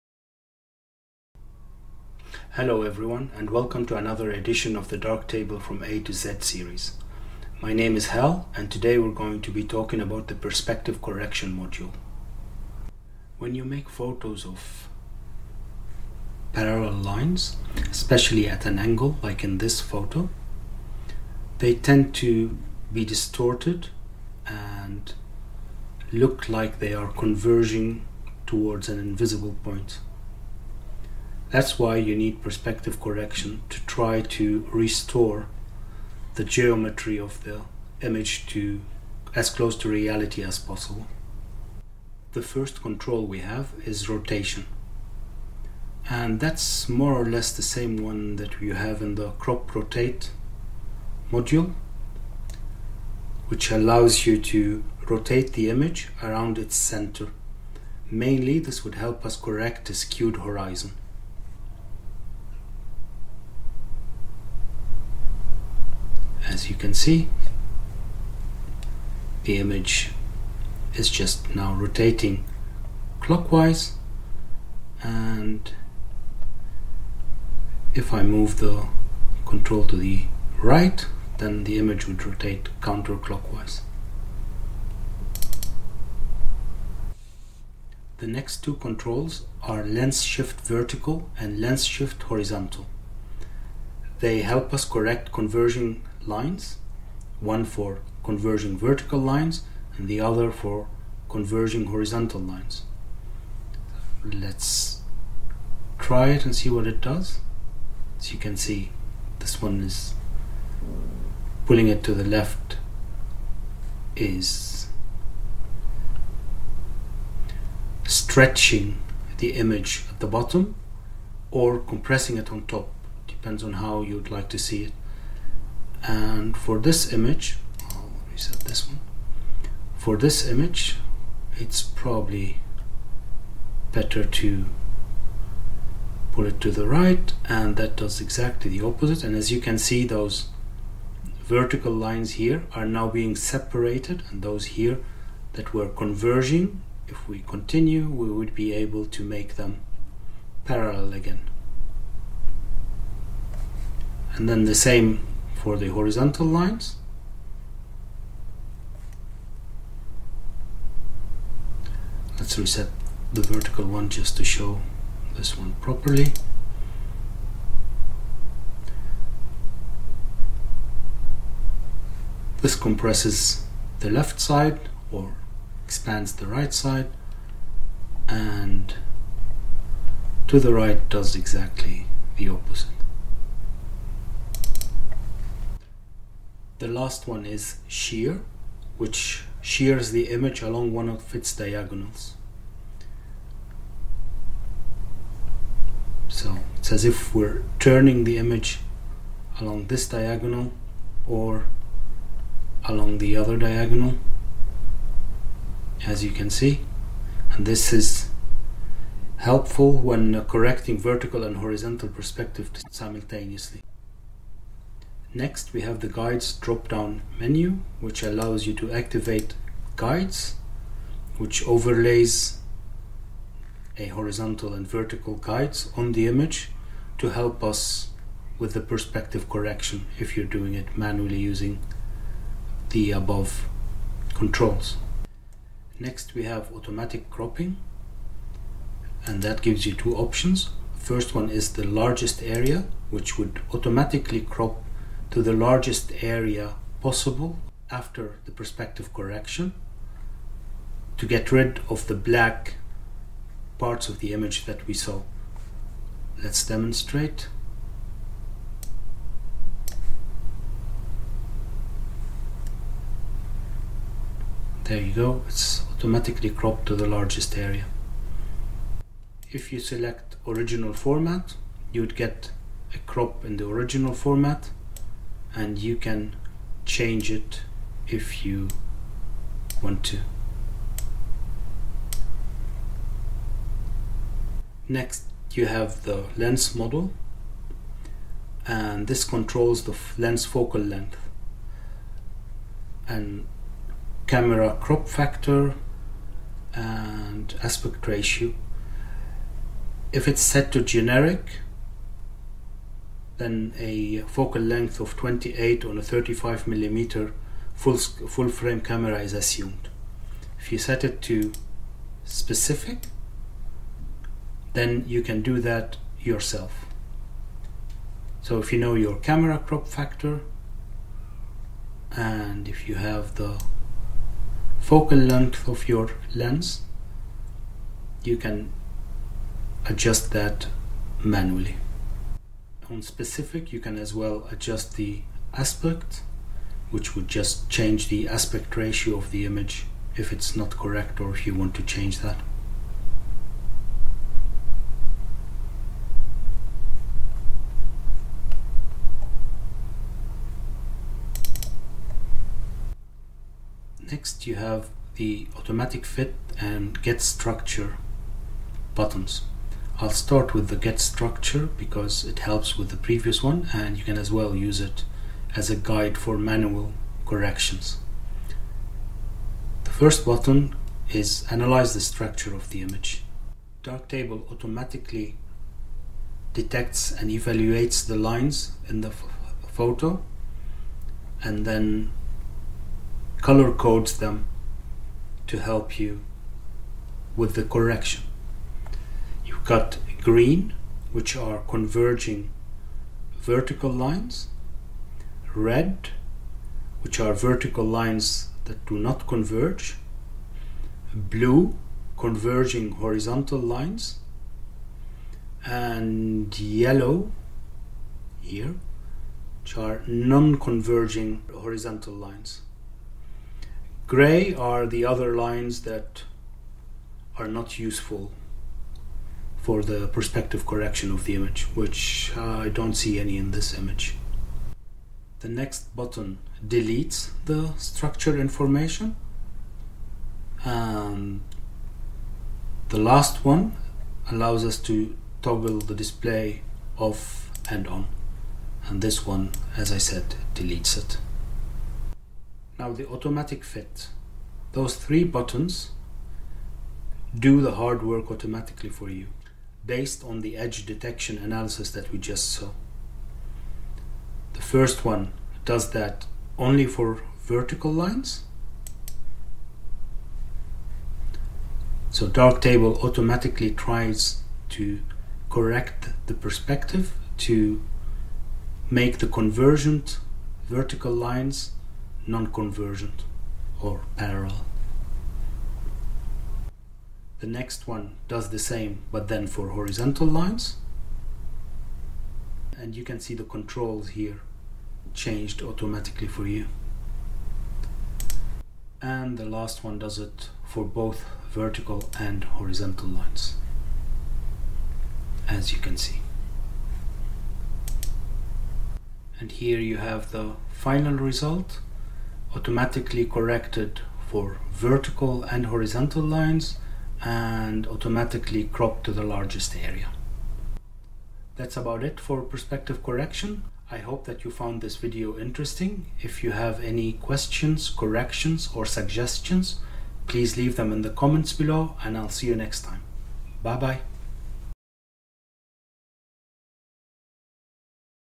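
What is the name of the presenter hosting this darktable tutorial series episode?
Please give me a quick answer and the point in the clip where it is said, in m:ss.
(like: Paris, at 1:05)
Hal, at 0:08.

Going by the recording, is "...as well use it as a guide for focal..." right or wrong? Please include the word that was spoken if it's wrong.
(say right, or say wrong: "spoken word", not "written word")
wrong: "manual", not "focal".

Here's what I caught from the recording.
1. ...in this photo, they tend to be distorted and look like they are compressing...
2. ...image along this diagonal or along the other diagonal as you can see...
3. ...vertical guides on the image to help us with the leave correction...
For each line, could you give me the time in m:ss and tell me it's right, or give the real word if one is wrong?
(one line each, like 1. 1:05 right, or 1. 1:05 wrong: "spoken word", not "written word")
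1. 0:19 wrong: "converging", not "compressing"
2. 3:18 right
3. 3:44 wrong: "perspective", not "leave".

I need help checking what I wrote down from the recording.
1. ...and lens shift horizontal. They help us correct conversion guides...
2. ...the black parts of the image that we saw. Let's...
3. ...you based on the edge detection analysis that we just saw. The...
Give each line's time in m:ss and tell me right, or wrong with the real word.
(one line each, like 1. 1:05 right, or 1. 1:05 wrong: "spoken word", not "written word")
1. 1:31 wrong: "lines", not "guides"
2. 4:12 right
3. 7:29 right.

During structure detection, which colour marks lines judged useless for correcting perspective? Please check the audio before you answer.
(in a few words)
gray.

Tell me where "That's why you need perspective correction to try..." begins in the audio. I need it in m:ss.
0:31.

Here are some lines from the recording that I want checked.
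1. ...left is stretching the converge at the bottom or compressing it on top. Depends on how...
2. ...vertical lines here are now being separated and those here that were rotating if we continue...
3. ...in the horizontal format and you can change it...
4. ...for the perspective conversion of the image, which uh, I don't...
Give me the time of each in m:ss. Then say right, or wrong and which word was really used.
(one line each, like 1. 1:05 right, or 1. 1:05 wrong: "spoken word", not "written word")
1. 1:52 wrong: "image", not "converge"
2. 2:21 wrong: "converging", not "rotating"
3. 4:33 wrong: "original", not "horizontal"
4. 6:59 wrong: "correction", not "conversion".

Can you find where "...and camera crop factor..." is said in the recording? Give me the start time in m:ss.
4:53.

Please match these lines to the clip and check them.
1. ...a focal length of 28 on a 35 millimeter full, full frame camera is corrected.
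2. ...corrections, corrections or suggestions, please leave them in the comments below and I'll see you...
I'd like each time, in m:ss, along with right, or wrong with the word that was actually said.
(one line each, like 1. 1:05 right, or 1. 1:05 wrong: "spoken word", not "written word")
1. 5:03 wrong: "assumed", not "corrected"
2. 8:37 wrong: "questions", not "corrections".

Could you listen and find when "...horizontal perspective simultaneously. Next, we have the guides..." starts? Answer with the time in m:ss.
3:31.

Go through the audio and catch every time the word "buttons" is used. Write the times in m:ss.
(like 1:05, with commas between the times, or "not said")
5:58, 6:10, 7:05, 7:25.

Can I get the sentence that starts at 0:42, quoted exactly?
The first control we have is rotation.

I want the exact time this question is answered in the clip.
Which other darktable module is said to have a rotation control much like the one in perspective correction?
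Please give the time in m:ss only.
0:49.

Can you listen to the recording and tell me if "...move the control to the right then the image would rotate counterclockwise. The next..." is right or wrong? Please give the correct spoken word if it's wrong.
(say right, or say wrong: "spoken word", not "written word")
right.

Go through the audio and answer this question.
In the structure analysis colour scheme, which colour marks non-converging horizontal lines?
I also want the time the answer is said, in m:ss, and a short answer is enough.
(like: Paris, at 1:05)
yellow, at 6:46.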